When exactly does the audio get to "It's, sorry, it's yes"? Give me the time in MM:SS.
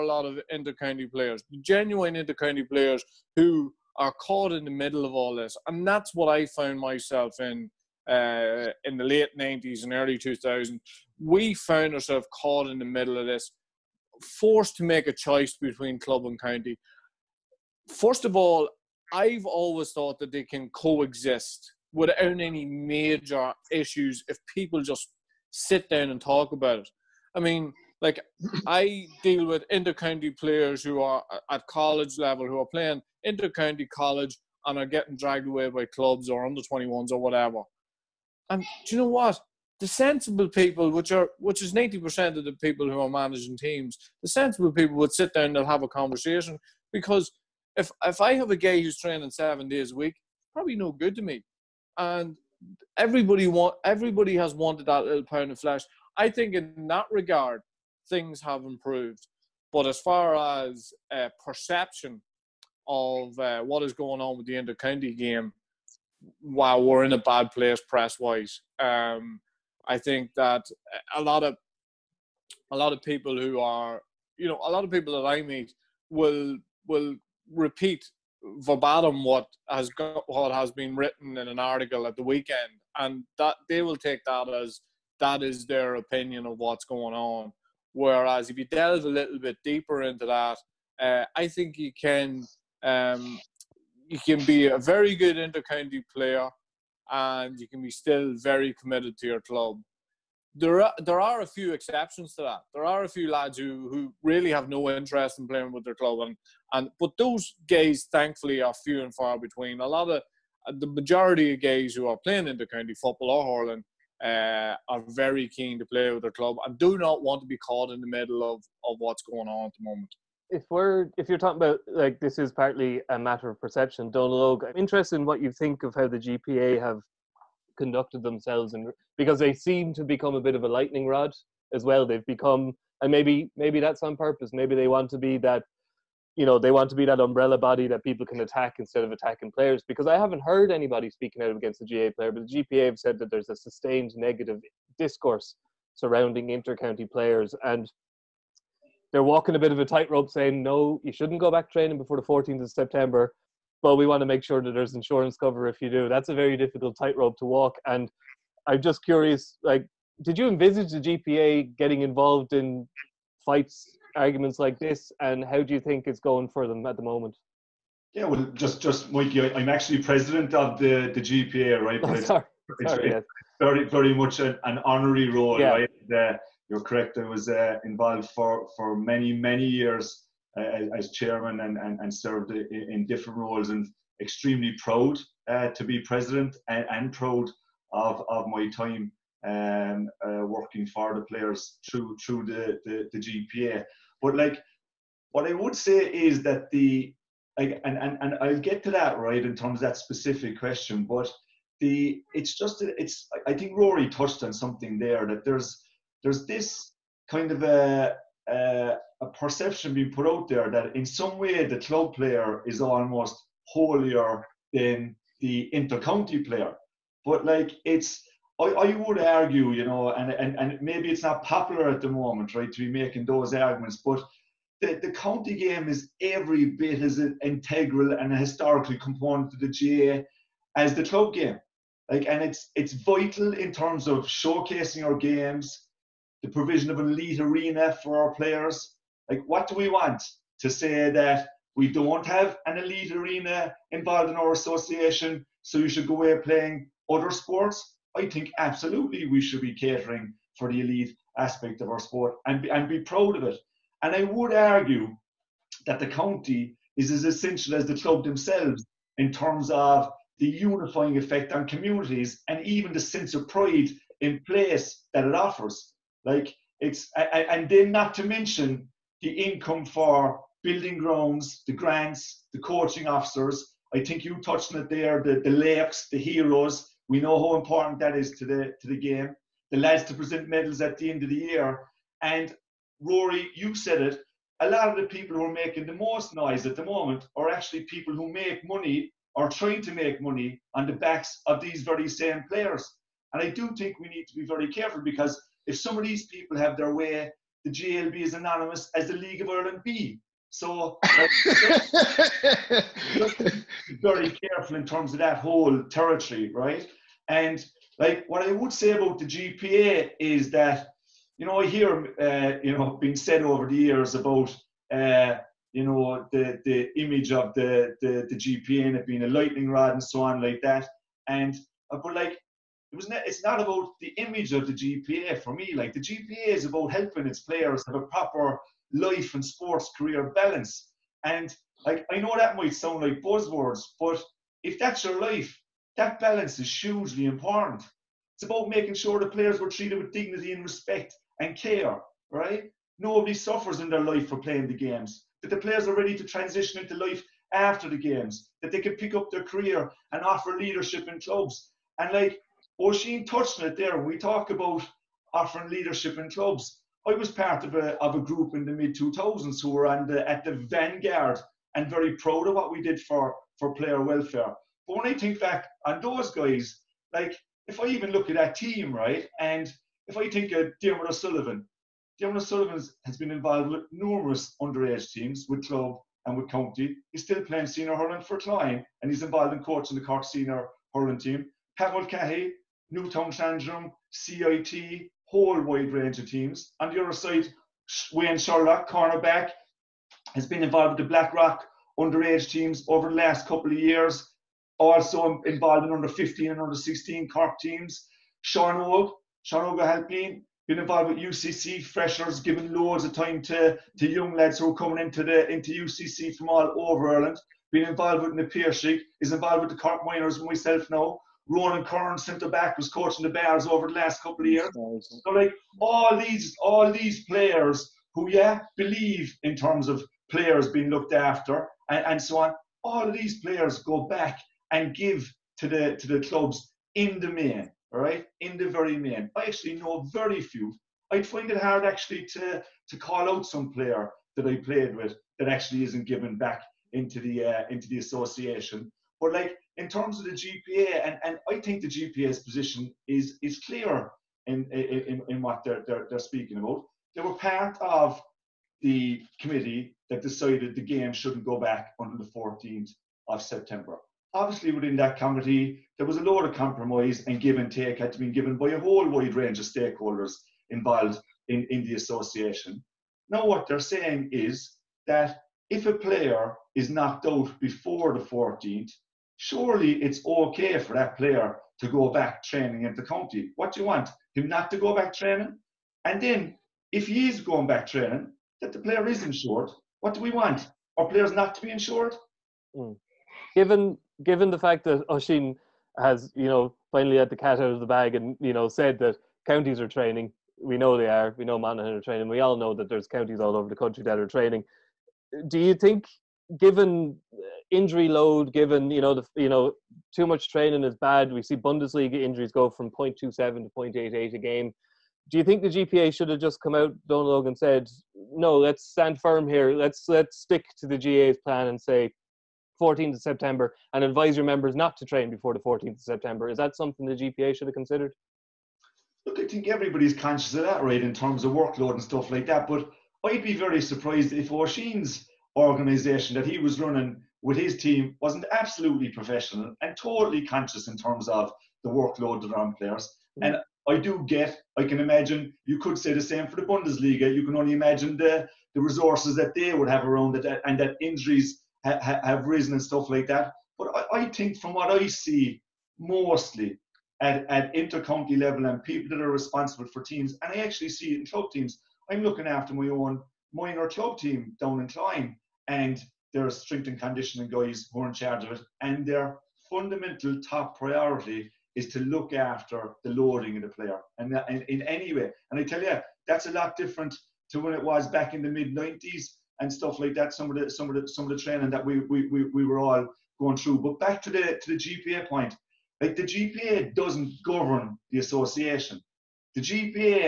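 02:52.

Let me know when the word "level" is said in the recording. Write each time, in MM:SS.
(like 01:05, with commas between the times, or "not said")
00:32, 09:08.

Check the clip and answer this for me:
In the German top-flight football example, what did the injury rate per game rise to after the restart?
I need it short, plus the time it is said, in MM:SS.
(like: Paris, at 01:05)
0.88, at 08:23.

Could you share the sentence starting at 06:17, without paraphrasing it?
He's still playing senior hurling for Cloyne, and he's involved in coaching the Cork senior hurling team.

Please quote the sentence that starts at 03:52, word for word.
Like and it's it's vital in terms of showcasing our games, the provision of an elite arena for our players.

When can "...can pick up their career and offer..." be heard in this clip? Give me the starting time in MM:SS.
05:48.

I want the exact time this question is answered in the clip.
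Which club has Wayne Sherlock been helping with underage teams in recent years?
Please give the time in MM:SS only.
06:31.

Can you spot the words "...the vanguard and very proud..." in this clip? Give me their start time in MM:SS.
06:00.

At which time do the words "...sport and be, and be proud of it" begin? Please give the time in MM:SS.
04:12.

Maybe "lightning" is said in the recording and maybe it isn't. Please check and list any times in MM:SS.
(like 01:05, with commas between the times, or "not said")
02:10, 05:19.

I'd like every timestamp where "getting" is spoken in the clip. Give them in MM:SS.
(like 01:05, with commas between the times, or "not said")
00:34, 02:41.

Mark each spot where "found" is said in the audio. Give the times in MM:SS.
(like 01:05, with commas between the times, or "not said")
00:06, 00:11.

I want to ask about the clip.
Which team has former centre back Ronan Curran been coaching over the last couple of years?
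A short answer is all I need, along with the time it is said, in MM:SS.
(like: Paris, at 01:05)
The Bears, at 06:53.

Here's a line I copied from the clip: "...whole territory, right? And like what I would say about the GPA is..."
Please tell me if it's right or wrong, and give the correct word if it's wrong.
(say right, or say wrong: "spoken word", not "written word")
right.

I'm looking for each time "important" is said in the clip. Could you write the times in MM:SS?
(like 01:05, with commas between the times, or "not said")
04:37, 05:37.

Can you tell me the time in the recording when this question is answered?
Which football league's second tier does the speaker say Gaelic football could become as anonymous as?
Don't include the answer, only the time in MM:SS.
04:59.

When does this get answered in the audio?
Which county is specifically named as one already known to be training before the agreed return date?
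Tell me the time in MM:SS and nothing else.
08:11.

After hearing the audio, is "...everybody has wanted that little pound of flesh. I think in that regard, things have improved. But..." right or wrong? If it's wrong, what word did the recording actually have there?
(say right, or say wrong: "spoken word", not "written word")
right.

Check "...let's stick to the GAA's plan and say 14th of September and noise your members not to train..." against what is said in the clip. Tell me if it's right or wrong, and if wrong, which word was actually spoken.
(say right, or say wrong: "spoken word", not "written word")
wrong: "advise", not "noise".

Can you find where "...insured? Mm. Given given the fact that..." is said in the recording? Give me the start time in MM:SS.
08:01.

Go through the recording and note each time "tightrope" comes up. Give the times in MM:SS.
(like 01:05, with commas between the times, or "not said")
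02:29, 02:36.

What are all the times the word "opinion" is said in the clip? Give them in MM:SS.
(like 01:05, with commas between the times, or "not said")
01:25.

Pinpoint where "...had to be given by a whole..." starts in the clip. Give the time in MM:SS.
07:37.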